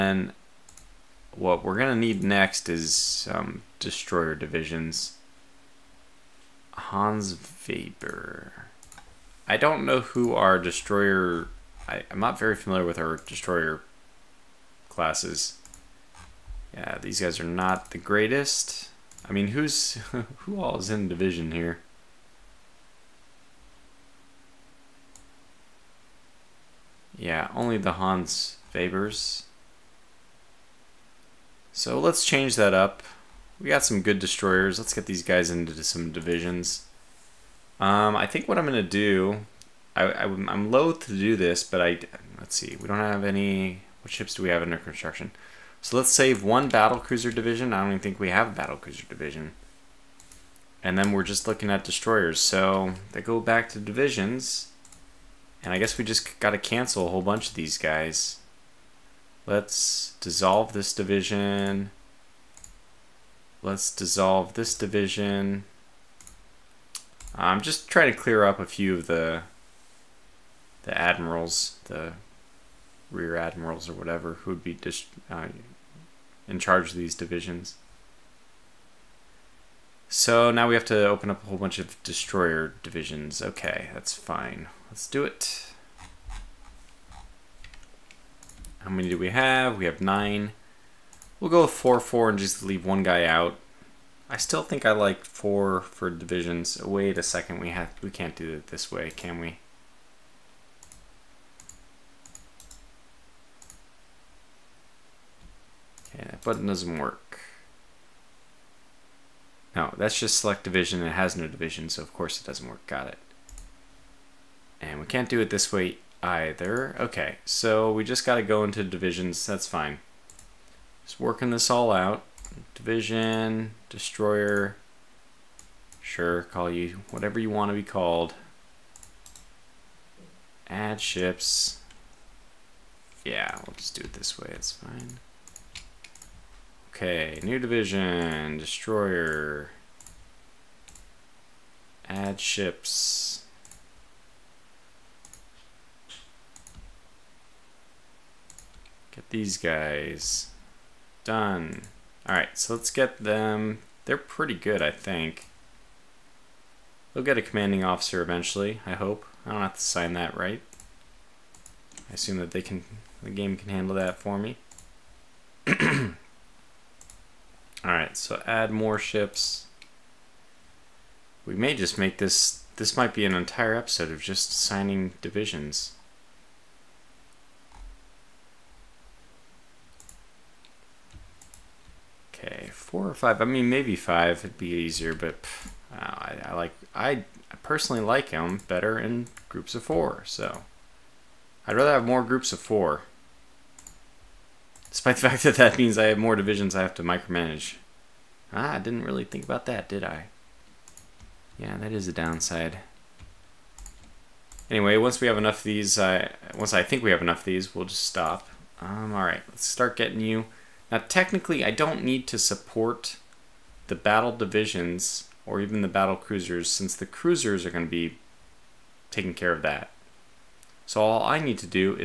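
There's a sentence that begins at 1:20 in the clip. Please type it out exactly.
So now we have to open up a whole bunch of destroyer divisions.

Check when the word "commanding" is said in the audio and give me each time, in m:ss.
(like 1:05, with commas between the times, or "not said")
2:37.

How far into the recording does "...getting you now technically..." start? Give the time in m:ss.
3:29.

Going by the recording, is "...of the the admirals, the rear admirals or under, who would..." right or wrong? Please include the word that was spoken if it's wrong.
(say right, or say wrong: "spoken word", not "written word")
wrong: "whatever", not "under".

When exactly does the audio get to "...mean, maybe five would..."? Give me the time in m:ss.
3:03.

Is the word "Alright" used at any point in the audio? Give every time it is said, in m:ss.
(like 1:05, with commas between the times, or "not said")
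2:32, 2:47.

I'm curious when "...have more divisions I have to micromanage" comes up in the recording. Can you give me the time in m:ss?
3:16.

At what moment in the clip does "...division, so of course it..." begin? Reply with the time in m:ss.
1:51.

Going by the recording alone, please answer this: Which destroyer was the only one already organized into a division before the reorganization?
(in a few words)
Hans Weber.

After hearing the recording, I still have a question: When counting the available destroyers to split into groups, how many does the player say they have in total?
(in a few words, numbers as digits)
9.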